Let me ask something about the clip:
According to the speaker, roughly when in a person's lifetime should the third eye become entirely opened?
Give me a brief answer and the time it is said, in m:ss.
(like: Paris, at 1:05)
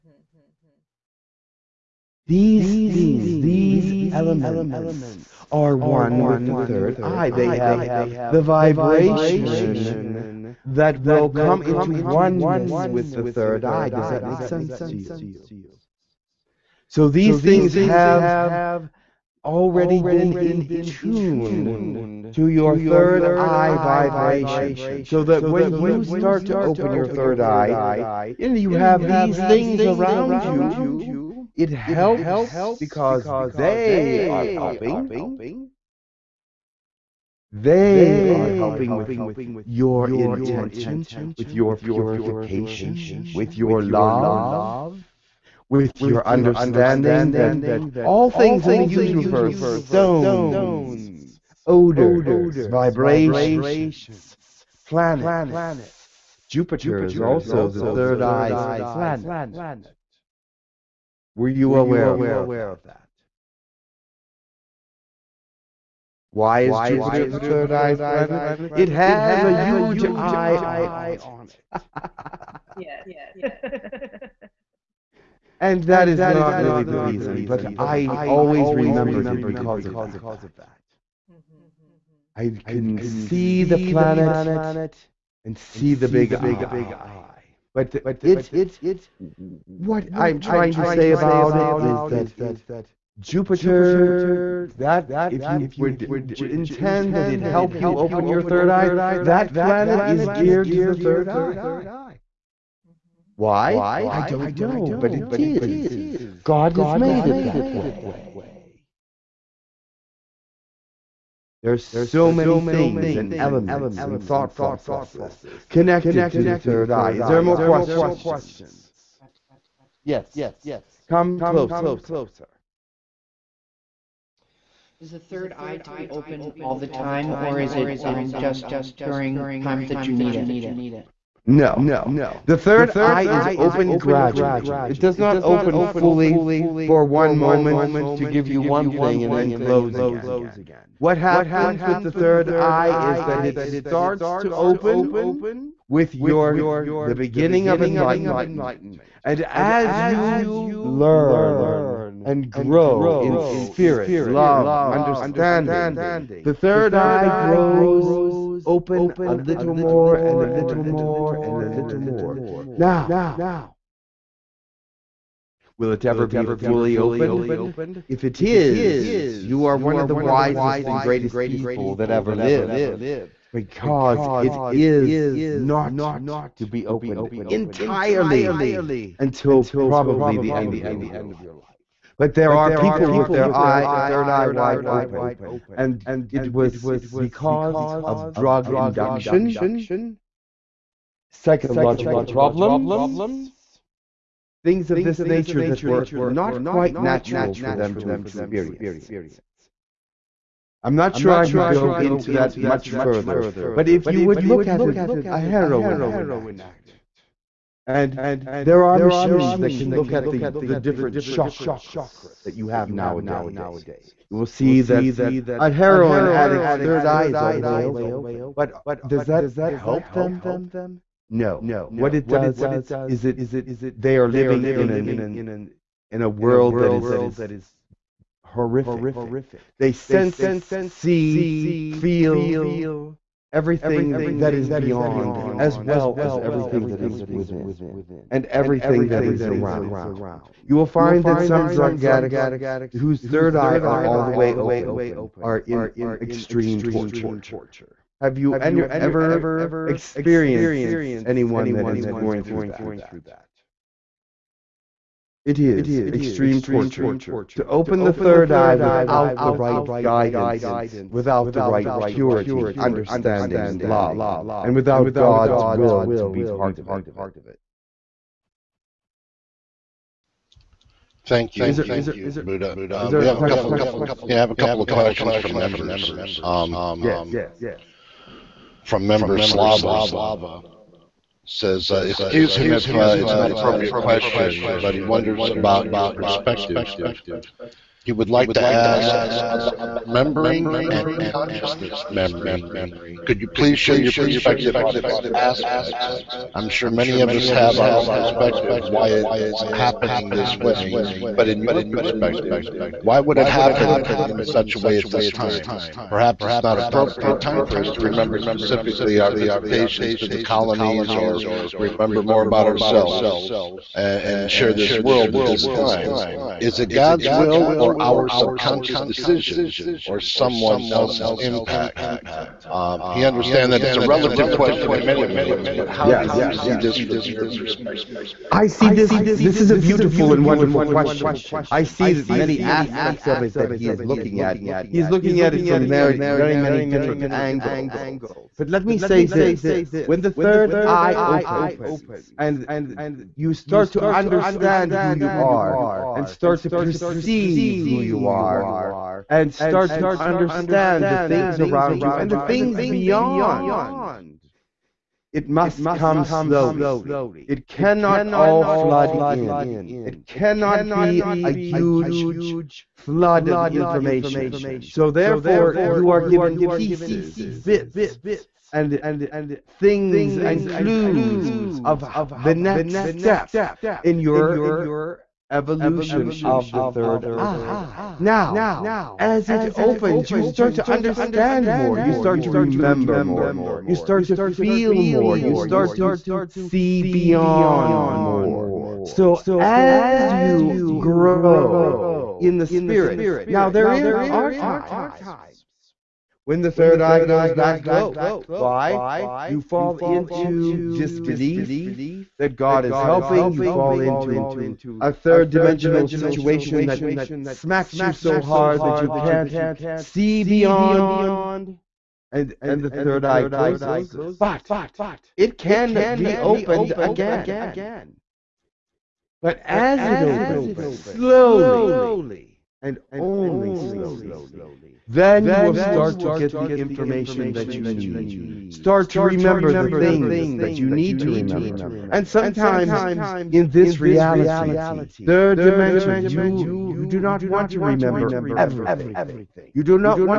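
end of your life, at 3:00.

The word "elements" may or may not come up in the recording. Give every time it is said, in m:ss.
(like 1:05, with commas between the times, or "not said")
0:04, 1:53.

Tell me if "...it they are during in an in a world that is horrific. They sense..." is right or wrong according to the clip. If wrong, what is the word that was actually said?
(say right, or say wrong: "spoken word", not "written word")
wrong: "living", not "during".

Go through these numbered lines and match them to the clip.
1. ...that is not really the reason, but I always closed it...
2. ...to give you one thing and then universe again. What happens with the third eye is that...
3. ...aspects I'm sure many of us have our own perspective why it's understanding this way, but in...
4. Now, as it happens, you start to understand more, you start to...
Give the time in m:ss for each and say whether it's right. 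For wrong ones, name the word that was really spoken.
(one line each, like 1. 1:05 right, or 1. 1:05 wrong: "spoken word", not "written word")
1. 1:15 wrong: "remembered", not "closed"
2. 2:18 wrong: "close", not "universe"
3. 4:55 wrong: "happening", not "understanding"
4. 6:18 wrong: "opens", not "happens".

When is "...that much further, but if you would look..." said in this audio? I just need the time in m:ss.
3:22.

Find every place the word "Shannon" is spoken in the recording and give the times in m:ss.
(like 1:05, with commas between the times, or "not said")
not said.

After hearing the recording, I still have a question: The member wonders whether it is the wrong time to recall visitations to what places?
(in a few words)
the colonies.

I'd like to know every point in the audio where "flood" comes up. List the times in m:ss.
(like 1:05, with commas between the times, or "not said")
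5:58, 6:02.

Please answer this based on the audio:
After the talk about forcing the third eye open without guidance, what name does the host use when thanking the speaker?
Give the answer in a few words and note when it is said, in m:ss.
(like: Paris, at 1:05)
Buddha, at 4:32.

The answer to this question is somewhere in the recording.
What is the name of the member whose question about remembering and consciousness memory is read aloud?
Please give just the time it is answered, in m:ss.
4:39.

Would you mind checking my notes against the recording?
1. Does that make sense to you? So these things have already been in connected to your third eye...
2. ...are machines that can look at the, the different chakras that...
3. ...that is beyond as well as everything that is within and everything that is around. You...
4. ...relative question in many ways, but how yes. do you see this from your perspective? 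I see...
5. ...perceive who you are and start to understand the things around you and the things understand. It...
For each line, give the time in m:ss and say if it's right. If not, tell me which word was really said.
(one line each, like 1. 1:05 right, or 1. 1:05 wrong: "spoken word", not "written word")
1. 0:13 wrong: "tuned", not "connected"
2. 3:28 right
3. 3:54 right
4. 5:24 right
5. 5:46 wrong: "beyond", not "understand".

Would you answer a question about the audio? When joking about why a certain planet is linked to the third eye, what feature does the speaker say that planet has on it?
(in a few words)
a huge eye.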